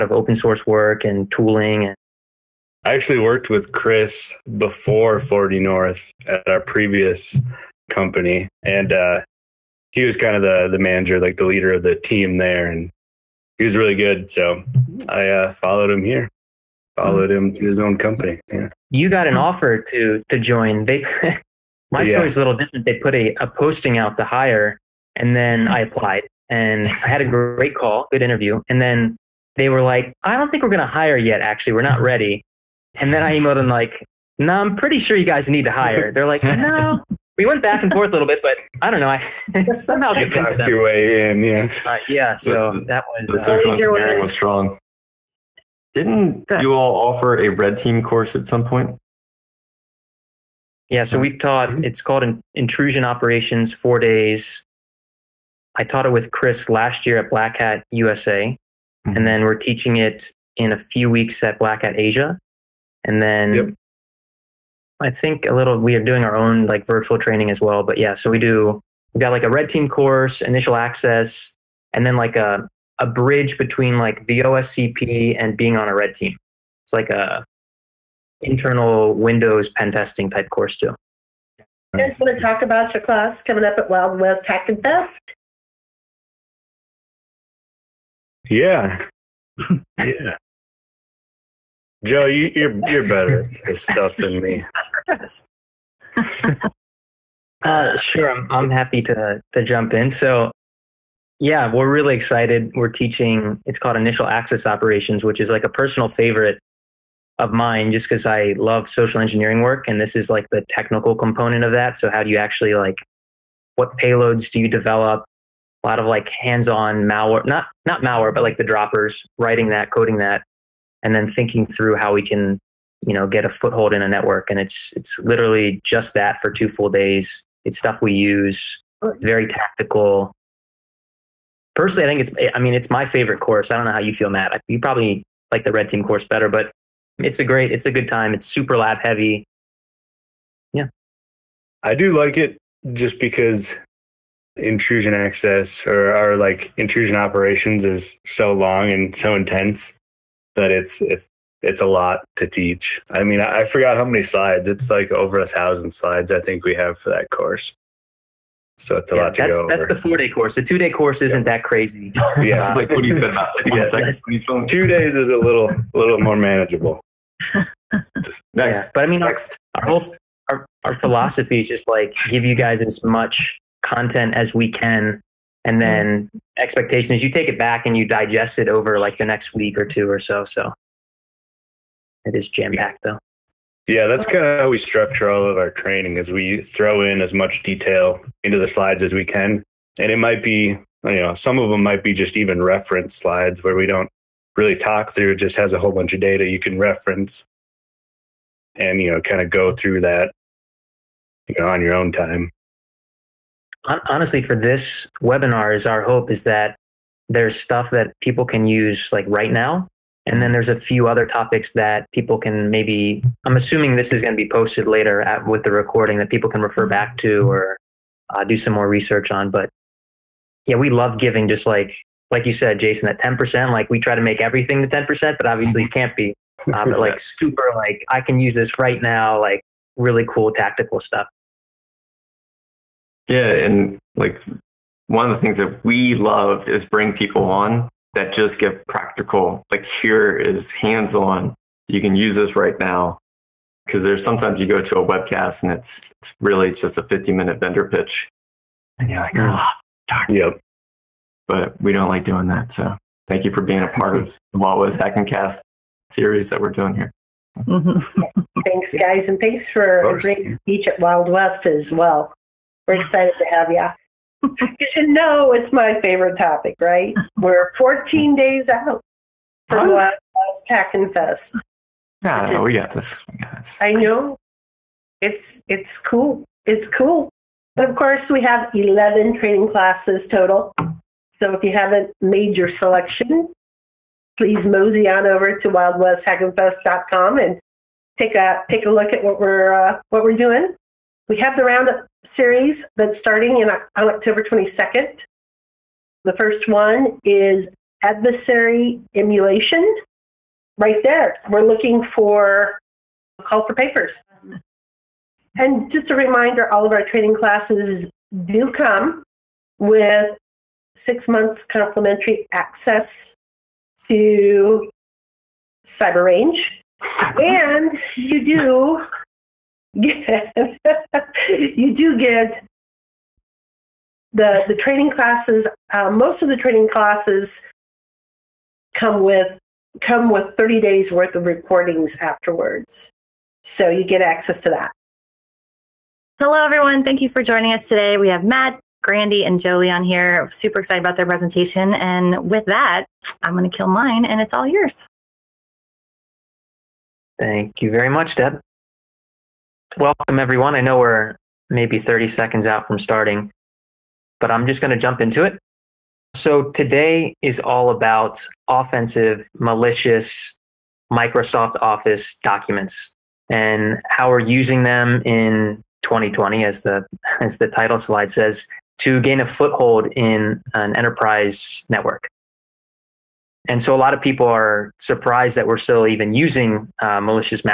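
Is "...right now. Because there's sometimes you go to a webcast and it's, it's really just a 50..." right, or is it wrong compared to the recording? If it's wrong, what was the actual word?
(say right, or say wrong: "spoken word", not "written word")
right.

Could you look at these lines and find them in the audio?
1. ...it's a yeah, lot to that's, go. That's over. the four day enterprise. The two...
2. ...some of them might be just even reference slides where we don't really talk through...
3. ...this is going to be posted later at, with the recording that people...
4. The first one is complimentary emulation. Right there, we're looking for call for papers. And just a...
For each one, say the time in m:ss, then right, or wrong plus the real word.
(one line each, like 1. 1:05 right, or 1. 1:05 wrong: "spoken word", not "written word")
1. 2:38 wrong: "course", not "enterprise"
2. 3:11 right
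3. 3:33 right
4. 4:56 wrong: "adversary", not "complimentary".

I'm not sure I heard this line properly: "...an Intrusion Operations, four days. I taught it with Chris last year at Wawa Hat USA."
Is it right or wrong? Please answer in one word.
wrong.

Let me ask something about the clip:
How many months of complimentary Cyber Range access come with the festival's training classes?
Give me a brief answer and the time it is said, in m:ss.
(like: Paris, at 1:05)
6, at 5:10.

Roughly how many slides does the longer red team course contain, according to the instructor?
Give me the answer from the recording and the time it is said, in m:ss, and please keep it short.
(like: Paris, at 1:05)
over 1,000, at 2:35.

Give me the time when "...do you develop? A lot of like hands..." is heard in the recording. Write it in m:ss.
1:54.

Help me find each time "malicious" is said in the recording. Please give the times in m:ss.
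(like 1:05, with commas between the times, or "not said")
5:59, 6:17.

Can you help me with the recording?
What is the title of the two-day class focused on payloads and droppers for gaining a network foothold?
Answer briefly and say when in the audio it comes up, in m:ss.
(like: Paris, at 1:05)
Initial Access Operations, at 1:43.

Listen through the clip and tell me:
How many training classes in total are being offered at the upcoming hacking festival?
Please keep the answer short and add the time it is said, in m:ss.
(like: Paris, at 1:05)
11, at 4:38.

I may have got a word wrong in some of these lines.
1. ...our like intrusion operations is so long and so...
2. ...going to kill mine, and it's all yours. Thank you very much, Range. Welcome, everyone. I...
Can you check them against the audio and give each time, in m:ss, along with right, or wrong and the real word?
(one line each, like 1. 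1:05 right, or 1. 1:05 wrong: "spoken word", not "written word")
1. 2:26 right
2. 5:43 wrong: "Deb", not "Range".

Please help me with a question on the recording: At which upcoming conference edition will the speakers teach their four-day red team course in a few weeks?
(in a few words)
Black Hat Asia.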